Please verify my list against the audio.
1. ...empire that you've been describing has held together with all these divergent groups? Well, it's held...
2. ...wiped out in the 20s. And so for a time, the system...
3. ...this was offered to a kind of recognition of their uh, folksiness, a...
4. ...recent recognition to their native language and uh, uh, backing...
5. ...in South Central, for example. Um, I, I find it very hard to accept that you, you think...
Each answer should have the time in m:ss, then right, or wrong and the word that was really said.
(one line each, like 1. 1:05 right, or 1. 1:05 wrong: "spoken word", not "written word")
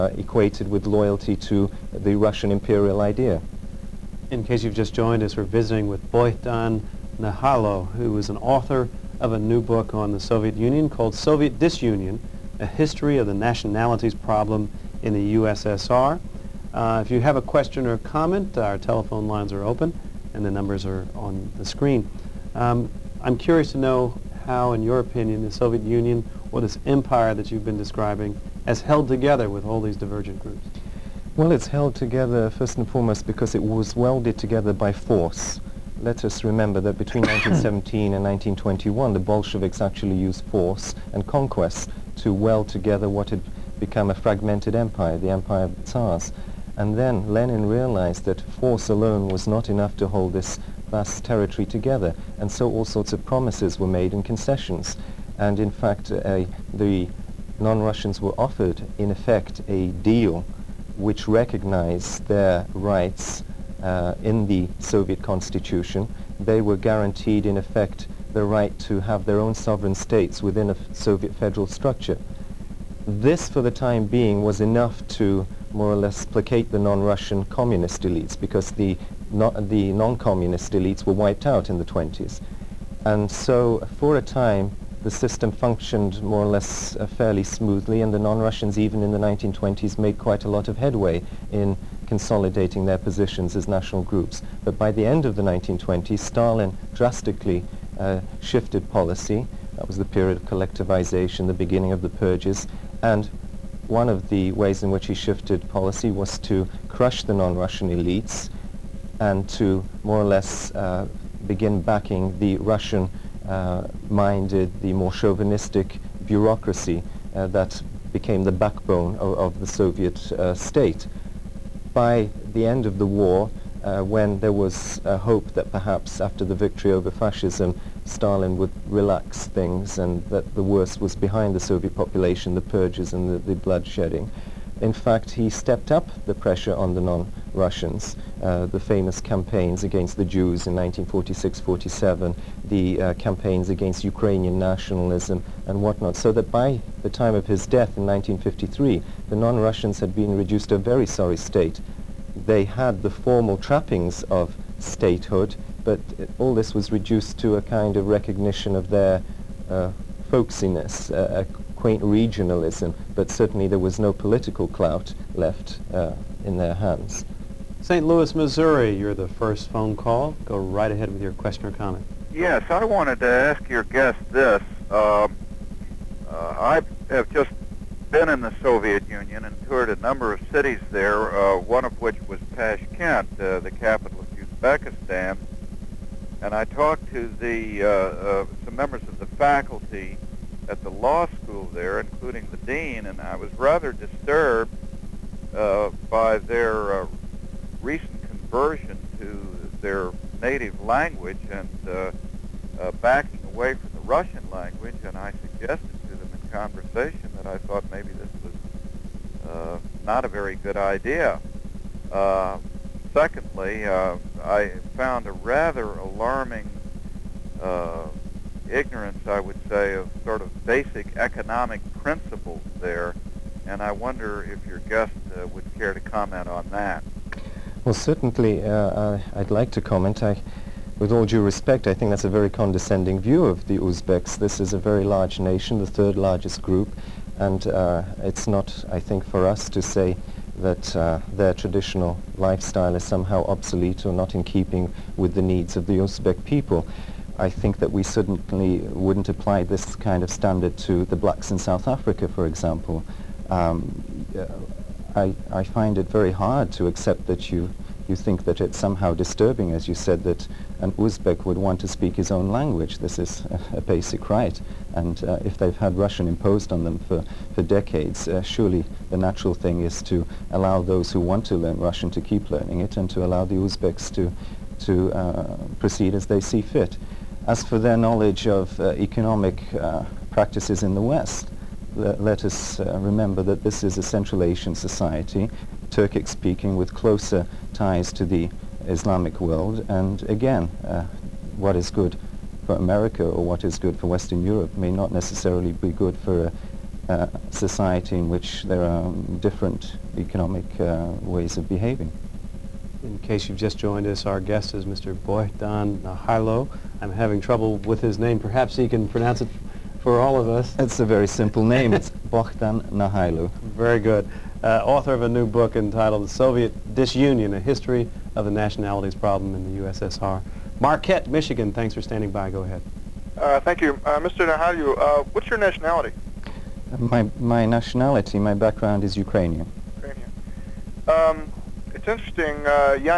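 1. 0:26 right
2. 1:21 right
3. 2:36 wrong: "reduced", not "offered"
4. 3:17 wrong: "conversion", not "recognition"
5. 4:11 wrong: "Africa", not "Central".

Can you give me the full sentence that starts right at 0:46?
And then Lenin realized that force alone was not enough to hold this territory together.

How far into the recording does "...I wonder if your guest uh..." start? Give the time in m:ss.
3:43.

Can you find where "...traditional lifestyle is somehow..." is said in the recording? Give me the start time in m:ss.
4:01.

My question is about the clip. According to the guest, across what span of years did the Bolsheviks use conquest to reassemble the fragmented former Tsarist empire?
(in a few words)
1917 to 1921.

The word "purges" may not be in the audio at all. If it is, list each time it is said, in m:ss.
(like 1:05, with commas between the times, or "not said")
1:42, 2:12.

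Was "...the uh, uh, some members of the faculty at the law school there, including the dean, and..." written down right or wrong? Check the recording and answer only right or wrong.
right.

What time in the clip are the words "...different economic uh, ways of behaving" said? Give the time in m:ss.
4:59.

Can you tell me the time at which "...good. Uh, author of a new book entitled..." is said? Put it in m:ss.
5:13.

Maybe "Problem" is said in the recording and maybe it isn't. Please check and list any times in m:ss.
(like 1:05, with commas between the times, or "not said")
0:14, 5:19.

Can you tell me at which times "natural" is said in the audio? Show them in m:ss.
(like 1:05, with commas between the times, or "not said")
4:29.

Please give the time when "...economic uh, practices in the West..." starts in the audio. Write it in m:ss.
4:38.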